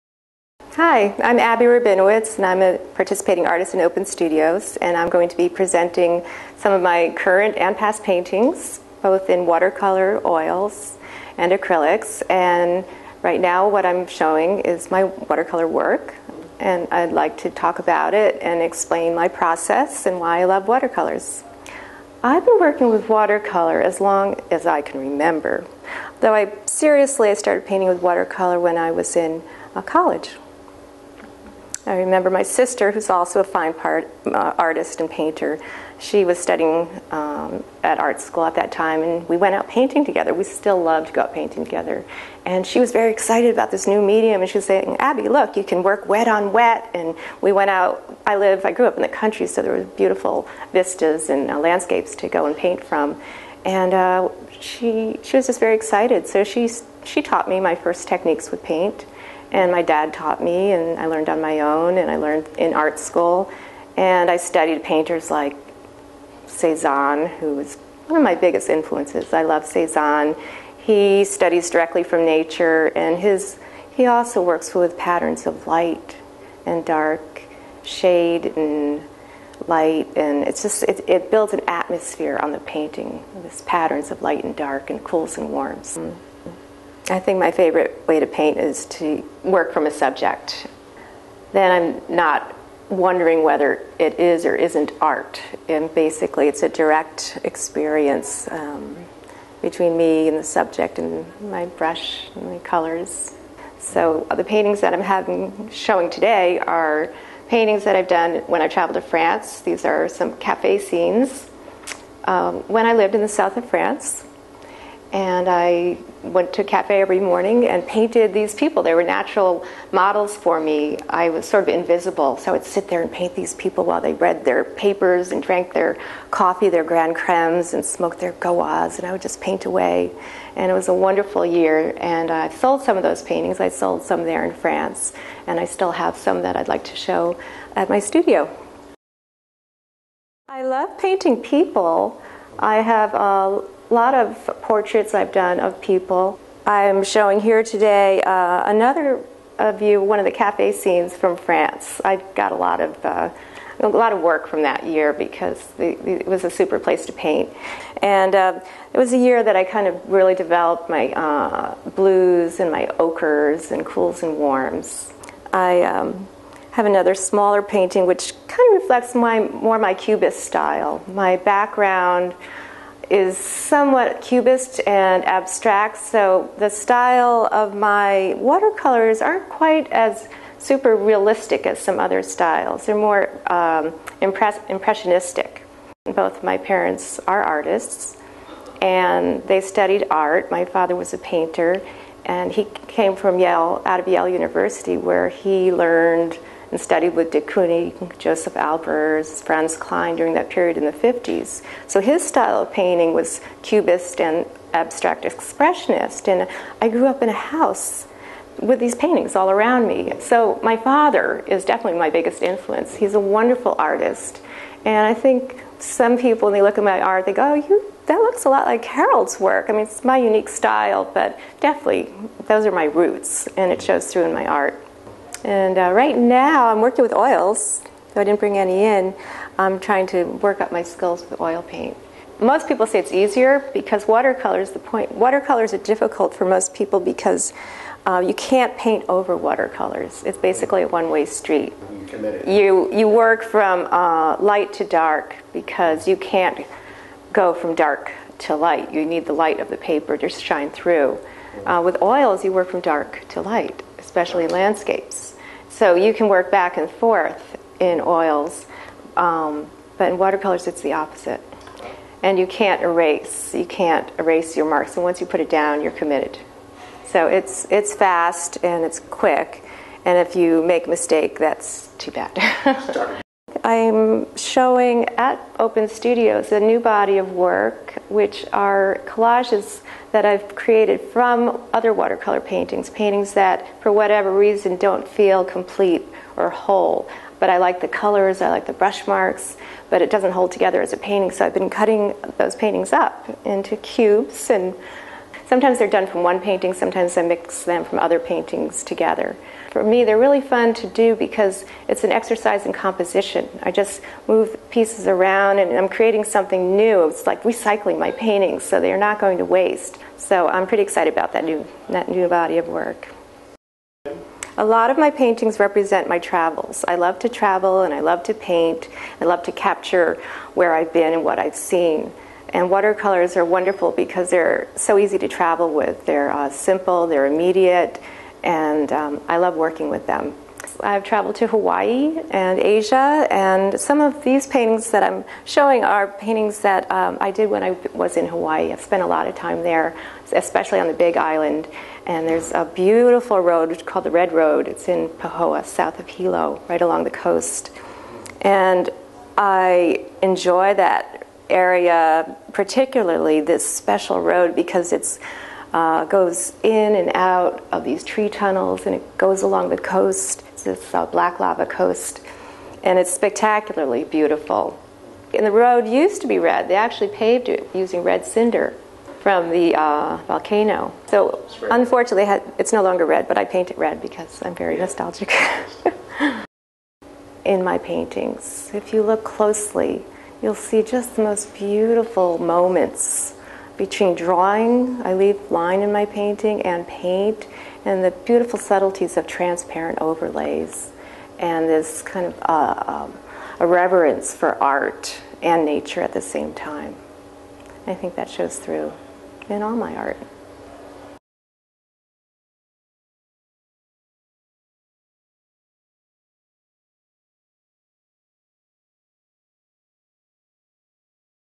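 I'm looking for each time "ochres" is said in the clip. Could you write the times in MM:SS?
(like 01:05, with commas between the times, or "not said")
02:42.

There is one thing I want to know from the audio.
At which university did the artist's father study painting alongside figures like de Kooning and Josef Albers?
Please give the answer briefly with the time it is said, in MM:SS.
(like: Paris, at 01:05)
Yale University, at 03:14.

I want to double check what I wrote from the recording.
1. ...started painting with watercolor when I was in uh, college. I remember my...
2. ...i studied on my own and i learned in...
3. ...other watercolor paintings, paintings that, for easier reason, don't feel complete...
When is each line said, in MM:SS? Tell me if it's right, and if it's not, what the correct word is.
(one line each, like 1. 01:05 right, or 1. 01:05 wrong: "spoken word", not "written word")
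1. 00:27 right
2. 01:00 wrong: "learned", not "studied"
3. 04:41 wrong: "whatever", not "easier".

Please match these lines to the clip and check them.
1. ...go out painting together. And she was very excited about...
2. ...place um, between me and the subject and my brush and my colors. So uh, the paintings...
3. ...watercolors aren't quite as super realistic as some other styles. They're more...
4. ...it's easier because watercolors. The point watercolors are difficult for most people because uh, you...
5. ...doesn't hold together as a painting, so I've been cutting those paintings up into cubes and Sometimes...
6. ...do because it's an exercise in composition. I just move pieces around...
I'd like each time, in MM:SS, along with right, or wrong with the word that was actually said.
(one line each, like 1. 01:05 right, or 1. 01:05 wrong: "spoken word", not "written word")
1. 00:41 right
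2. 01:37 wrong: "experience", not "place"
3. 02:58 right
4. 03:52 right
5. 04:50 right
6. 05:00 right.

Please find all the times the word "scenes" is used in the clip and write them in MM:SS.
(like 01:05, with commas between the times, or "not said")
01:50, 02:30.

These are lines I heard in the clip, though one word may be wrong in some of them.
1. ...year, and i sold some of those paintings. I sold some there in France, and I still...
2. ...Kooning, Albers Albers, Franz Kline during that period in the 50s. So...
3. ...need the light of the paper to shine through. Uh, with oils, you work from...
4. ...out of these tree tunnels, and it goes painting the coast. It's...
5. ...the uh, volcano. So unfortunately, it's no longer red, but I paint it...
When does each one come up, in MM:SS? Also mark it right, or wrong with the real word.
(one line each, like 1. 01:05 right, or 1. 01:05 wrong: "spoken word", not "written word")
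1. 02:11 right
2. 03:17 wrong: "Josef", not "Albers"
3. 04:09 right
4. 05:57 wrong: "along", not "painting"
5. 06:09 right.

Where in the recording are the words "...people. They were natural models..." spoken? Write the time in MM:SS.
01:58.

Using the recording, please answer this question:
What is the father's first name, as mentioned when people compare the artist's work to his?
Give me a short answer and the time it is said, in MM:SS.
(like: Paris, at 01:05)
Harold, at 03:38.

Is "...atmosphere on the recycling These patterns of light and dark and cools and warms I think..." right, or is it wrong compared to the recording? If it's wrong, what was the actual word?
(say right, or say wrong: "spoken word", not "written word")
wrong: "painting", not "recycling".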